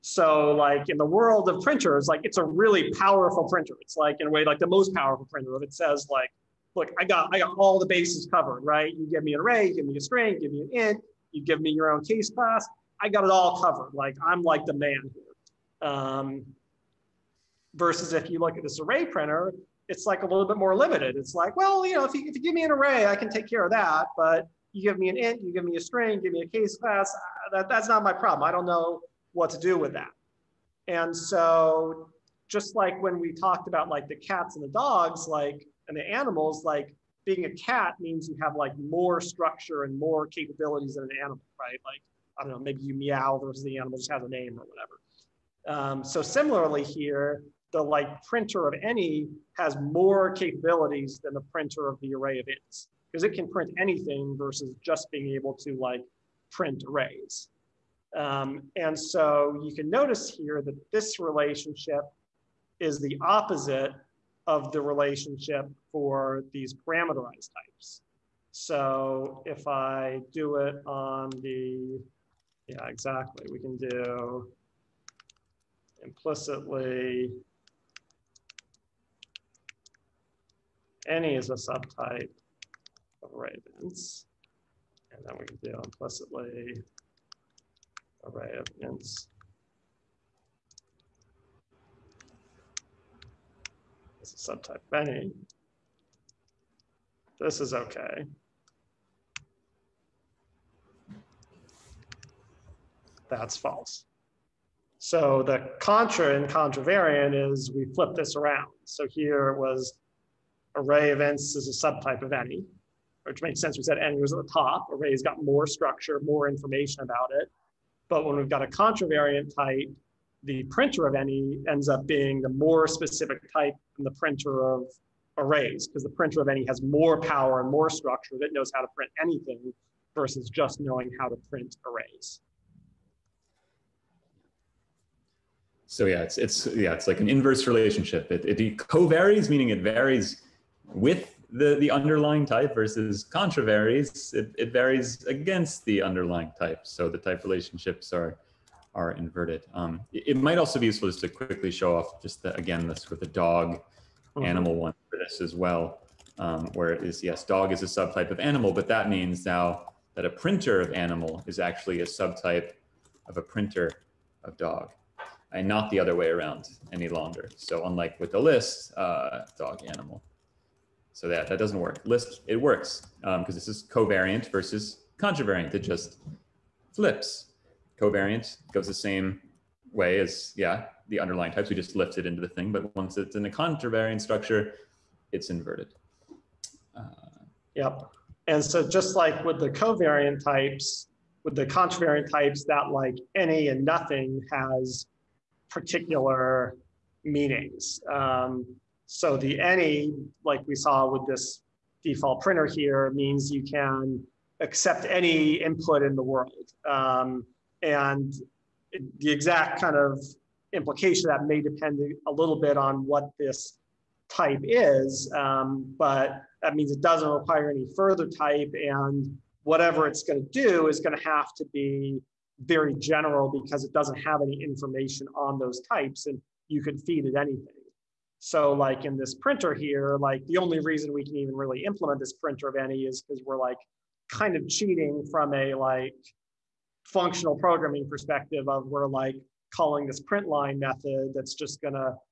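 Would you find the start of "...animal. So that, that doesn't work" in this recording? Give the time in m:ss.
2:49.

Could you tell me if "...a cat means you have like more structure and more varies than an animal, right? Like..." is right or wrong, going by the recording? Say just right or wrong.
wrong.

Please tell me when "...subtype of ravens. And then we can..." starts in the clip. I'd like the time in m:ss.
1:21.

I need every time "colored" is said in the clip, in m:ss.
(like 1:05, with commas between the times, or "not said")
not said.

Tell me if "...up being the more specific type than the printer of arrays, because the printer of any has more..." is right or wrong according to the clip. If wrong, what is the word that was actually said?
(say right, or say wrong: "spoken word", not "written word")
right.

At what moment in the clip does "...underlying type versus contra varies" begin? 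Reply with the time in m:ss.
2:21.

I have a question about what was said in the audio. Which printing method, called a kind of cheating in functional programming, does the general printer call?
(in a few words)
print line.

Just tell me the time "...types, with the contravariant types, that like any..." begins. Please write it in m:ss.
3:10.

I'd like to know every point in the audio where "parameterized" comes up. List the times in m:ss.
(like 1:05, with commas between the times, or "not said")
1:06.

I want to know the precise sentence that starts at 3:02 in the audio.
But once it's in the contravariant structure, it's inverted.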